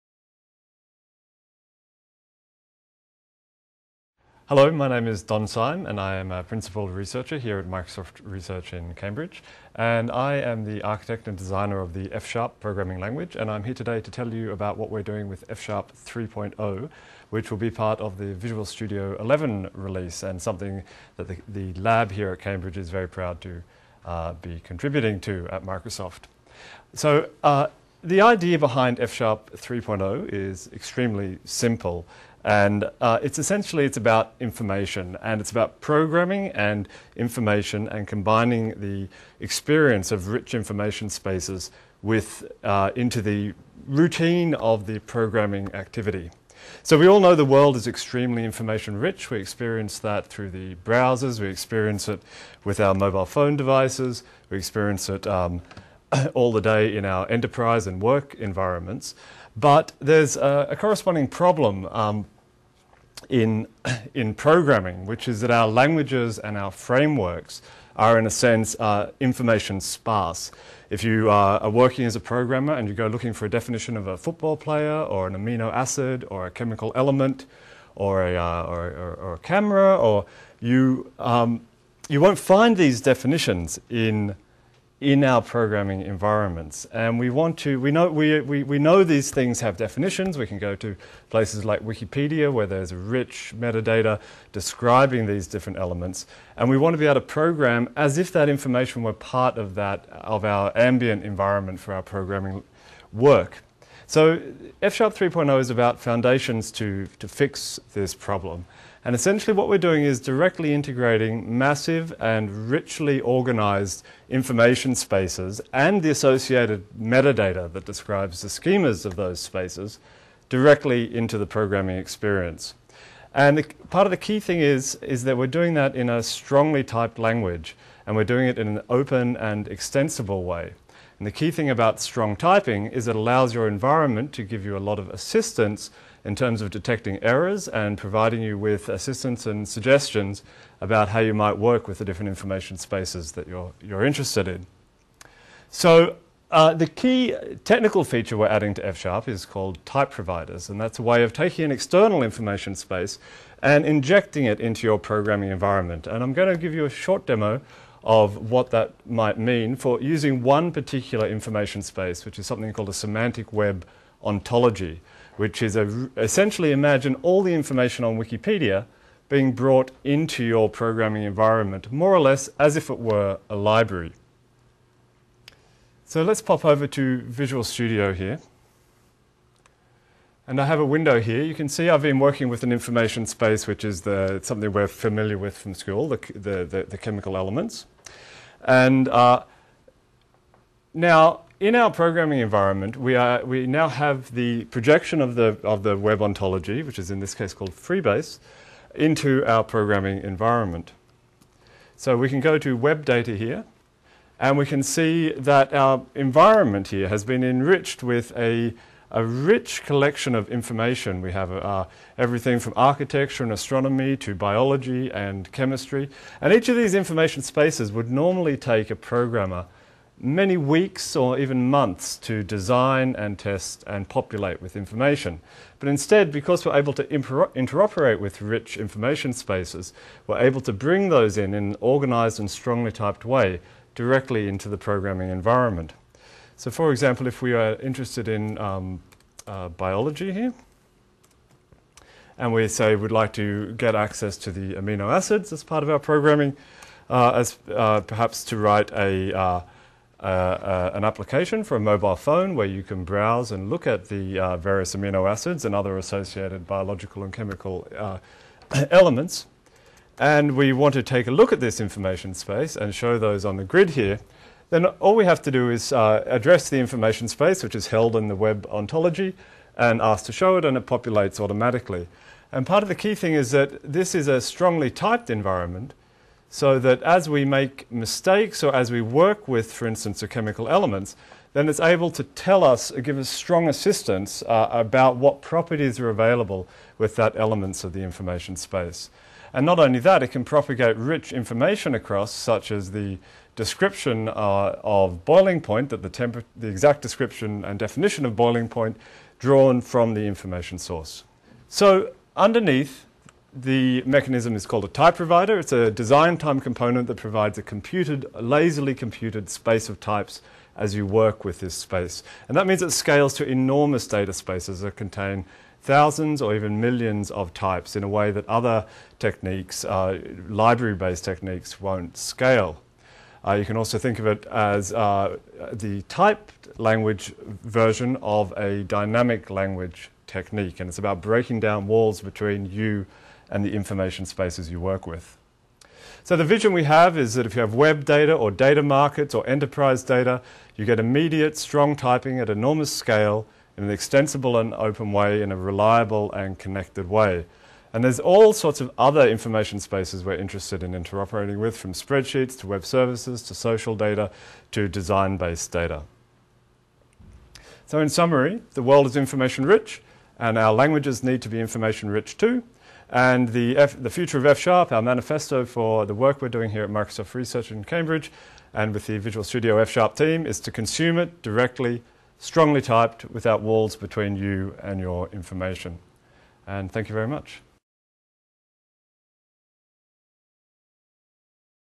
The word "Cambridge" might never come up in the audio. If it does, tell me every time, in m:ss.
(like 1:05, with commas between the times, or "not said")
0:08, 0:22, 6:07.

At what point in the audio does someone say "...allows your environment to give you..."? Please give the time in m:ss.
2:13.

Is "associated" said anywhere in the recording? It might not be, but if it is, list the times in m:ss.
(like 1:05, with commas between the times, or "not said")
1:56, 4:15.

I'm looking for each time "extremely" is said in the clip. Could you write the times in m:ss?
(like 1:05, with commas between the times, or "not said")
0:30, 0:47.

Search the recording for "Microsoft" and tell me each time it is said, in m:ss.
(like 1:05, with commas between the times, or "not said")
0:07, 0:25, 6:06.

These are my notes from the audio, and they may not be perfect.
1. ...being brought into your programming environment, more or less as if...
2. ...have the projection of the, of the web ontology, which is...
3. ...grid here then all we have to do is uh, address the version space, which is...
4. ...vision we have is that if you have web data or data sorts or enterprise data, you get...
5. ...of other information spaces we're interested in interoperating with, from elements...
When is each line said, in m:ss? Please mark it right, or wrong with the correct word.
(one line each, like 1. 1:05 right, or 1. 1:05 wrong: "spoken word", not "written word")
1. 2:49 right
2. 3:13 right
3. 4:23 wrong: "information", not "version"
4. 5:36 wrong: "markets", not "sorts"
5. 5:48 wrong: "spreadsheets", not "elements".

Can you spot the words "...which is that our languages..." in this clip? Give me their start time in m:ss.
1:05.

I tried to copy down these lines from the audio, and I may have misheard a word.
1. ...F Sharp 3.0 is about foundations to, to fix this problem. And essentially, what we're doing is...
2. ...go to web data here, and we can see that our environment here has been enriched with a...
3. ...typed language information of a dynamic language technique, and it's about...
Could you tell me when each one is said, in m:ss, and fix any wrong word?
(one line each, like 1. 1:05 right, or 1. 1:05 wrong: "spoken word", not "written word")
1. 1:44 right
2. 3:22 right
3. 5:26 wrong: "version", not "information".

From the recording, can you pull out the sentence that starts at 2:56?
So let's pop over to Visual Studio here.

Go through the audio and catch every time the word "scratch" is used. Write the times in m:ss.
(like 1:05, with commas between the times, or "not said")
not said.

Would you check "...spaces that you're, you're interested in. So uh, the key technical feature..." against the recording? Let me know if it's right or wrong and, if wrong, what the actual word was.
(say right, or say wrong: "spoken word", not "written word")
right.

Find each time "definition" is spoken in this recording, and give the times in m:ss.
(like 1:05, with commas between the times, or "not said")
1:13, 1:23, 1:29, 4:57.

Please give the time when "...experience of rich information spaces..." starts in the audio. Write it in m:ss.
0:39.